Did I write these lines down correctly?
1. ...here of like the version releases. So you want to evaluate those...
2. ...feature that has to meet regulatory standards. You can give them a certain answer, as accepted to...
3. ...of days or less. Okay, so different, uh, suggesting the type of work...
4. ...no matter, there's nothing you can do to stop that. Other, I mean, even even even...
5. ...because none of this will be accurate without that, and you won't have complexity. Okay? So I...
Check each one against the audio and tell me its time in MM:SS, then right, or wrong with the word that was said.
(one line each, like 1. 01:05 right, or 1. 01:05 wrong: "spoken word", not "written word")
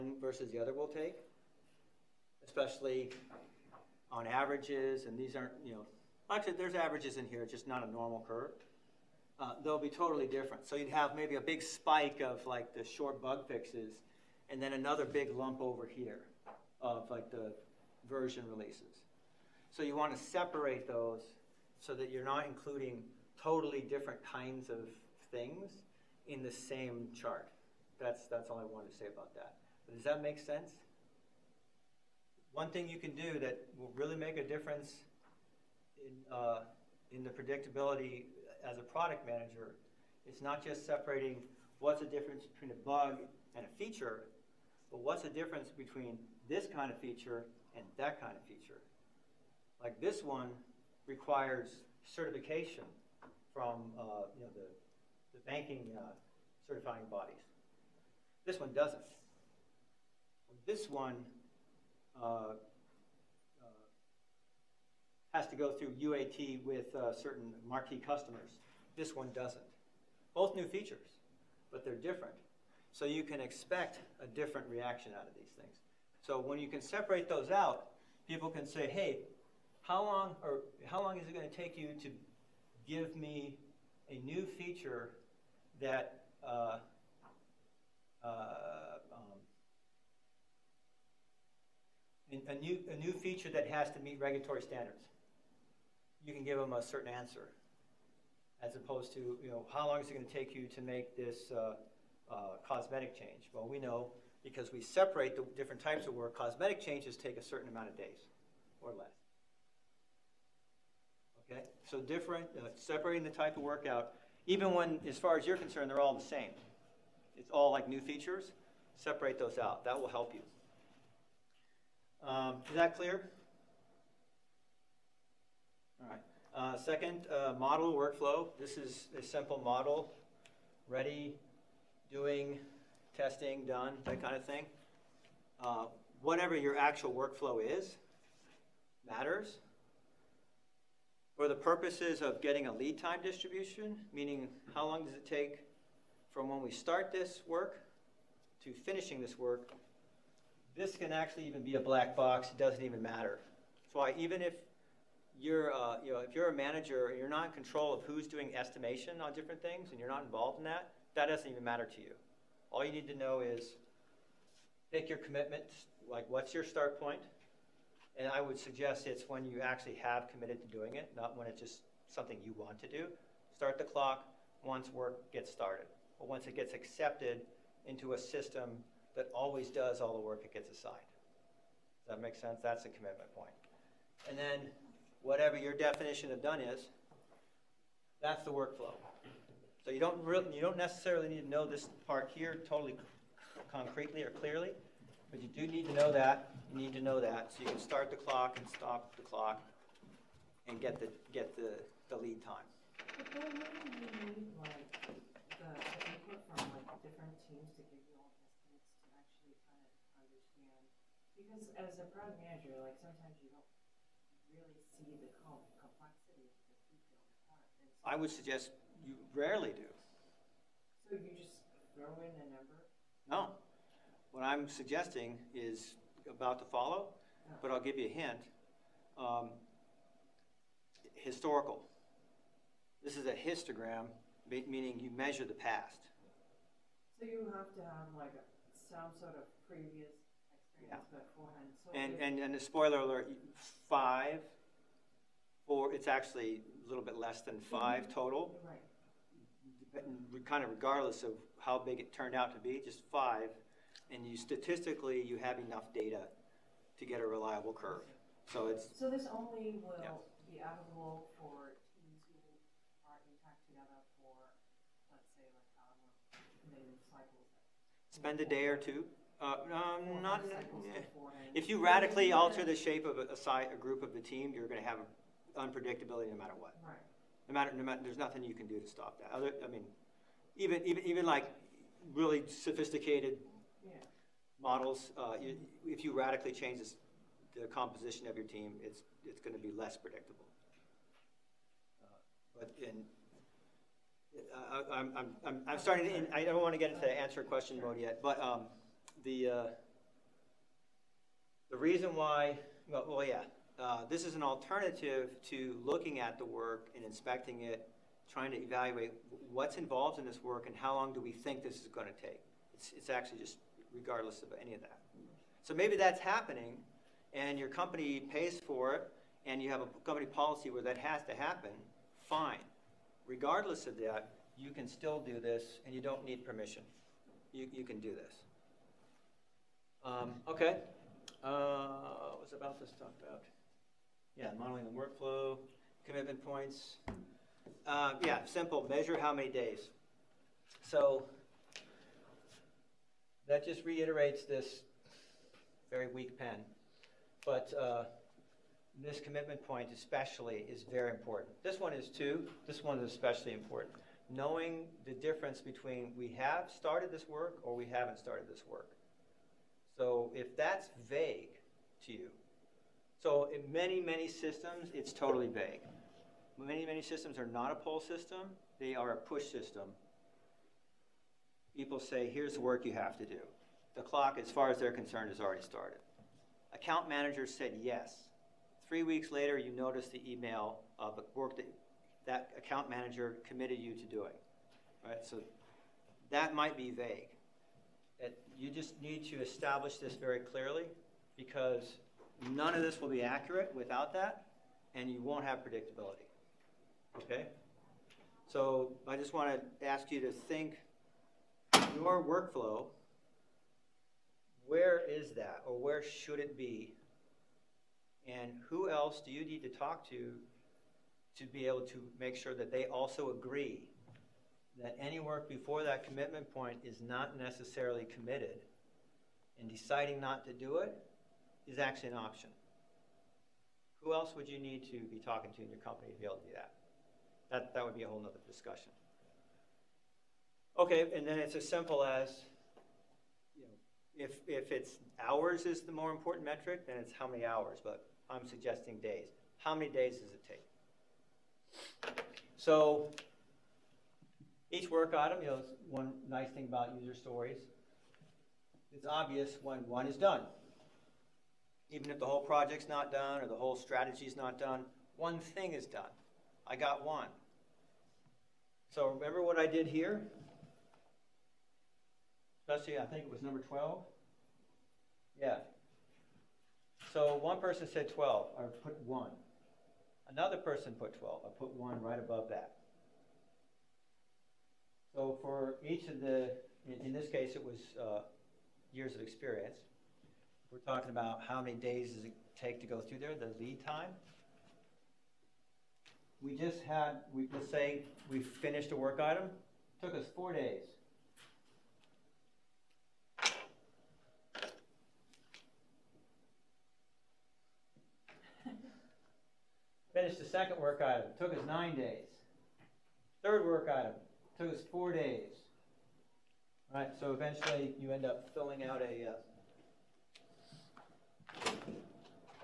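1. 00:15 wrong: "separate", not "evaluate"
2. 01:33 wrong: "opposed", not "accepted"
3. 01:47 wrong: "separating", not "suggesting"
4. 04:37 right
5. 06:31 wrong: "predictability", not "complexity".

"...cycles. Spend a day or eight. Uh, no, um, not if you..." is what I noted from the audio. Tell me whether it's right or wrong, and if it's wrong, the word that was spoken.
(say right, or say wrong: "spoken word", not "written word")
wrong: "two", not "eight".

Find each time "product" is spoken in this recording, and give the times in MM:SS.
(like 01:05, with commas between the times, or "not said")
00:38, 03:32.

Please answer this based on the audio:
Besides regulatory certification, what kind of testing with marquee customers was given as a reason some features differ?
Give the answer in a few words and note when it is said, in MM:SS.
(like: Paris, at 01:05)
UAT, at 01:05.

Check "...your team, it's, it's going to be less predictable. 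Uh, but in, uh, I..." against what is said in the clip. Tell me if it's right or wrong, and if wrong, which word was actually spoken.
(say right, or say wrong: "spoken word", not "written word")
right.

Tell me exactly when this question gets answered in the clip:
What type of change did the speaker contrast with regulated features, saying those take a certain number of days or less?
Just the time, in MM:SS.
01:42.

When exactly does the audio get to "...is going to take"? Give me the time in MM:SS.
05:11.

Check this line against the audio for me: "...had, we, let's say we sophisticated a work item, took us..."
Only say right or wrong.
wrong.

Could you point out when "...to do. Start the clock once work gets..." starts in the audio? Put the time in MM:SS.
02:52.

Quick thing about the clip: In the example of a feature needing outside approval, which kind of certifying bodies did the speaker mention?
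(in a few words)
banking.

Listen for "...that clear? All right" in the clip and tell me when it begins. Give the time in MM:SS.
02:02.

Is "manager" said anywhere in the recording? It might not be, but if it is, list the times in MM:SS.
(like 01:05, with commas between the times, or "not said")
00:39, 02:36, 03:32, 06:17, 06:22.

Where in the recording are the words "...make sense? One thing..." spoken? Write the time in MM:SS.
00:30.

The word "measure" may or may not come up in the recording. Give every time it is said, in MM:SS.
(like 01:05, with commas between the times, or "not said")
03:55, 05:38.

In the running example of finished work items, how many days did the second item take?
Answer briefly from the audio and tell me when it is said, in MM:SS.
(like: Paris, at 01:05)
9, at 08:21.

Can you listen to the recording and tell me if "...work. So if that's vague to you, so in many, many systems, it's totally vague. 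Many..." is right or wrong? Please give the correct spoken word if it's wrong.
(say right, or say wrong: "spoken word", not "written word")
right.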